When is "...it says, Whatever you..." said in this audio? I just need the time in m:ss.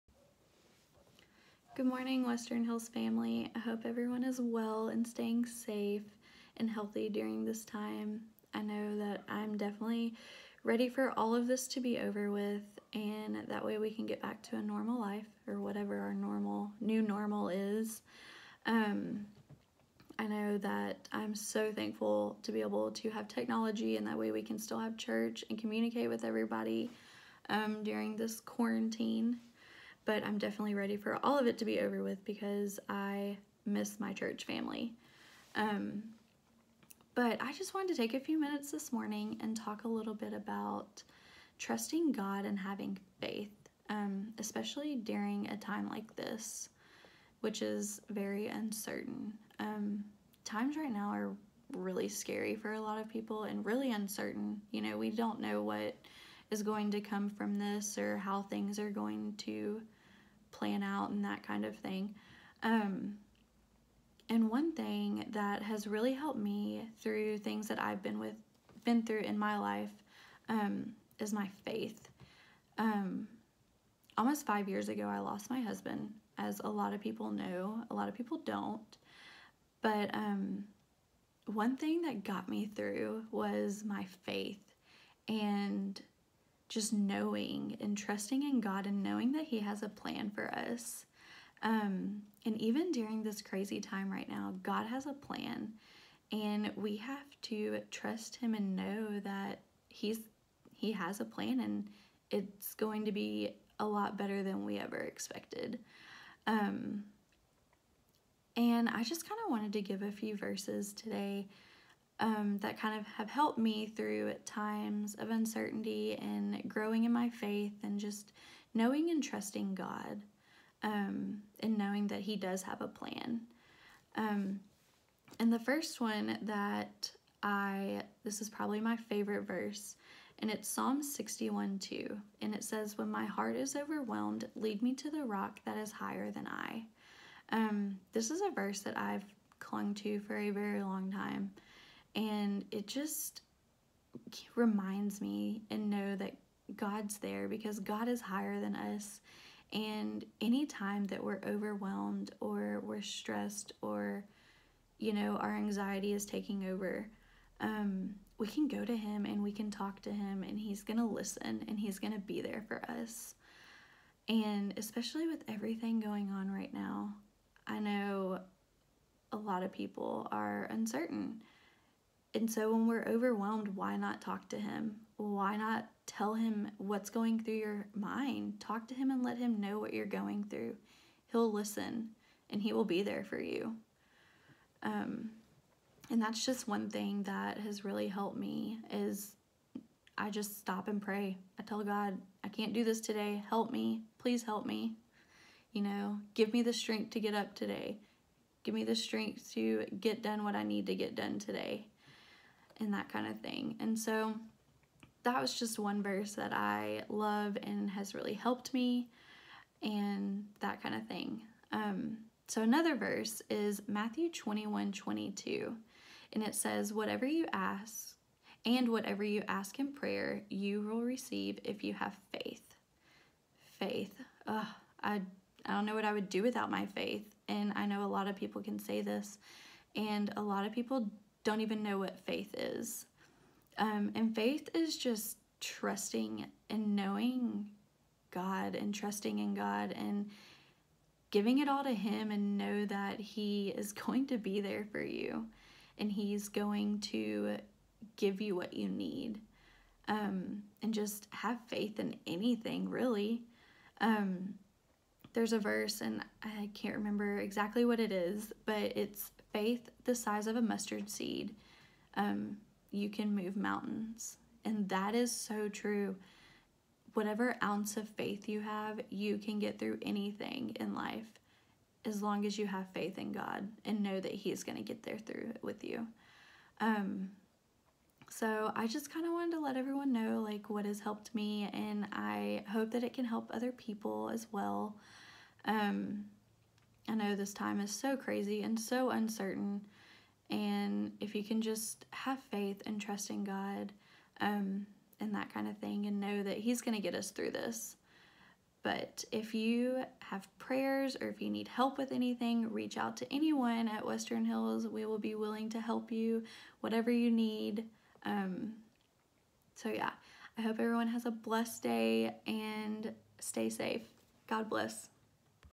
3:36.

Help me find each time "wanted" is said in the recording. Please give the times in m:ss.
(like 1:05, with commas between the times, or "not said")
0:37, 1:49, 4:39.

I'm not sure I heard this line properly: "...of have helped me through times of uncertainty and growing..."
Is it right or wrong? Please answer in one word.
right.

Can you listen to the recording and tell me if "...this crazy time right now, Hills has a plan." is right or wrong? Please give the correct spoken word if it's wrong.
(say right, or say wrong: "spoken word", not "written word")
wrong: "God", not "Hills".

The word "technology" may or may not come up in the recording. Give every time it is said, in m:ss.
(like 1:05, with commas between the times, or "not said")
0:23.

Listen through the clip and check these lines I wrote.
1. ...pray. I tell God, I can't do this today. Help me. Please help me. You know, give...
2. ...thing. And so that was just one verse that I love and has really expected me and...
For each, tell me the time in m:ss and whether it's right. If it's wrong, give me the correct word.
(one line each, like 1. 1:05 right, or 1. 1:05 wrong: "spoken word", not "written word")
1. 3:11 right
2. 3:23 wrong: "helped", not "expected".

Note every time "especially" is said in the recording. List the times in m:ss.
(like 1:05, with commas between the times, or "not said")
0:44, 2:44.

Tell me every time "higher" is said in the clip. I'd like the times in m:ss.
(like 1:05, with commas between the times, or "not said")
2:15, 2:28.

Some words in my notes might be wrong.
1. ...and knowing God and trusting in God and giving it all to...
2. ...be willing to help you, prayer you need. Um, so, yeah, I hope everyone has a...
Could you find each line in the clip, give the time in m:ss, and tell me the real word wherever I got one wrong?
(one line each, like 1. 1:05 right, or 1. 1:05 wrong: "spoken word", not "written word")
1. 3:56 right
2. 5:05 wrong: "whatever", not "prayer".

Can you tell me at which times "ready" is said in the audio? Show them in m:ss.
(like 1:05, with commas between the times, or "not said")
0:10, 0:30.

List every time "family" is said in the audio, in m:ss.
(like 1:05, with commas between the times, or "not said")
0:02, 0:34.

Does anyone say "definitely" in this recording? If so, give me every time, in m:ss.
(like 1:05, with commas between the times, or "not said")
0:09, 0:30.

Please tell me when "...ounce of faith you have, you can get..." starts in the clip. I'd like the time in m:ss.
4:27.